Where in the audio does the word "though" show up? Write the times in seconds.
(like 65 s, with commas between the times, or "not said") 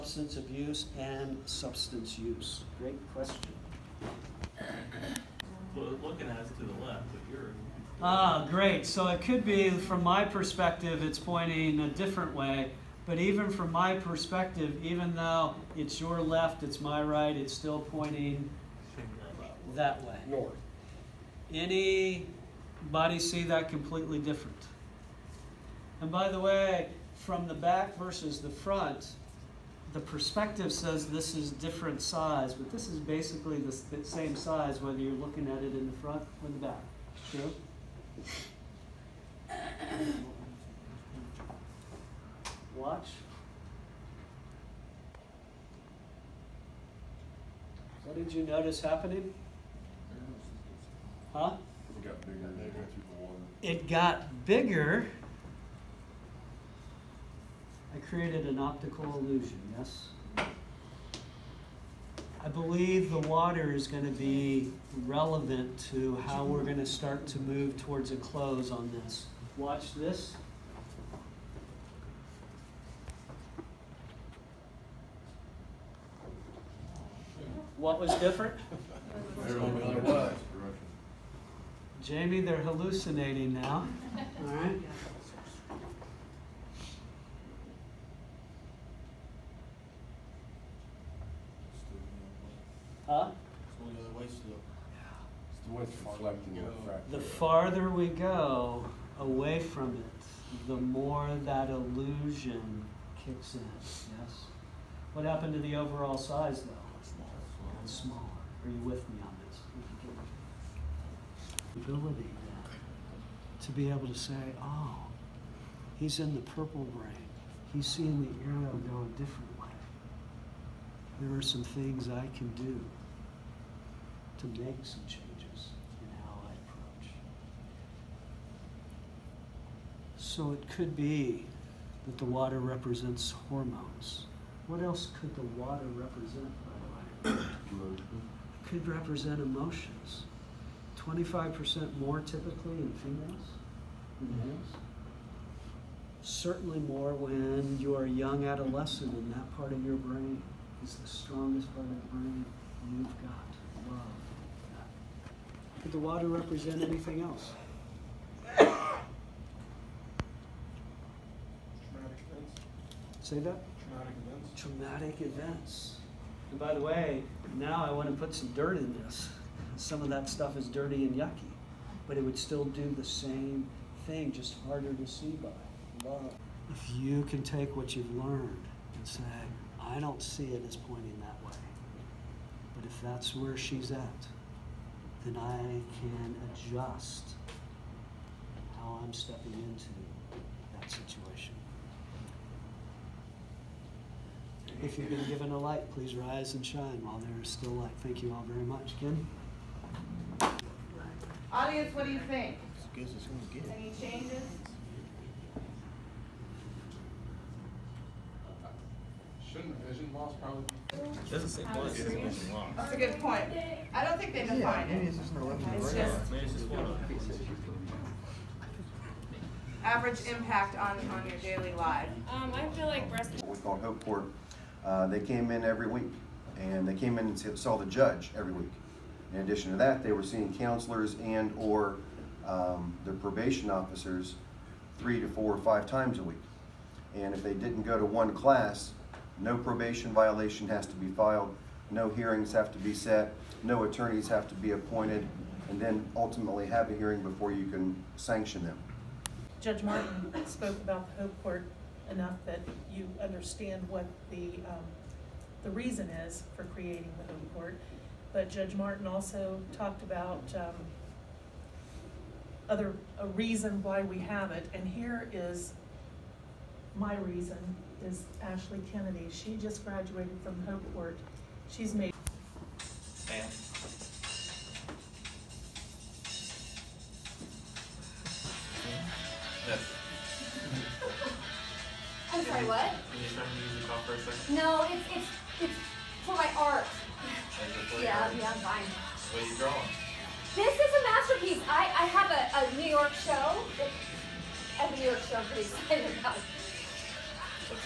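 15 s, 106 s.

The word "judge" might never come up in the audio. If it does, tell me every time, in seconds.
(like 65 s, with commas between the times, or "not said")
227 s, 249 s, 258 s.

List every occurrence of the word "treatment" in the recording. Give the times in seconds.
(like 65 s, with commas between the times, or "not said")
not said.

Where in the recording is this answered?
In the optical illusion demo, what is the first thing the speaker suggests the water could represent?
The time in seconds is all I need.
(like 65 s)
133 s.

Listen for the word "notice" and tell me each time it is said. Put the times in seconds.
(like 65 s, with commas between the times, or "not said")
48 s.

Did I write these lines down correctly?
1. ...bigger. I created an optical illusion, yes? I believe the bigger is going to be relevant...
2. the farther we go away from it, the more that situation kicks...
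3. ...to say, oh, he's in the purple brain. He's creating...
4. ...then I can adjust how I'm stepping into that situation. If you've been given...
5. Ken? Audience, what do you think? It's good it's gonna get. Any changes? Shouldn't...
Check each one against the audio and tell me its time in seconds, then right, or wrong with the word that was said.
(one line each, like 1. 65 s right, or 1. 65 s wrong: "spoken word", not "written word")
1. 54 s wrong: "water", not "bigger"
2. 97 s wrong: "illusion", not "situation"
3. 114 s wrong: "seeing", not "creating"
4. 185 s right
5. 198 s right.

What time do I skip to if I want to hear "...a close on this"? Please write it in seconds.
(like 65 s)
68 s.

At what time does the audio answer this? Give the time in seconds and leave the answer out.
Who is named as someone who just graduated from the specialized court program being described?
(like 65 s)
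268 s.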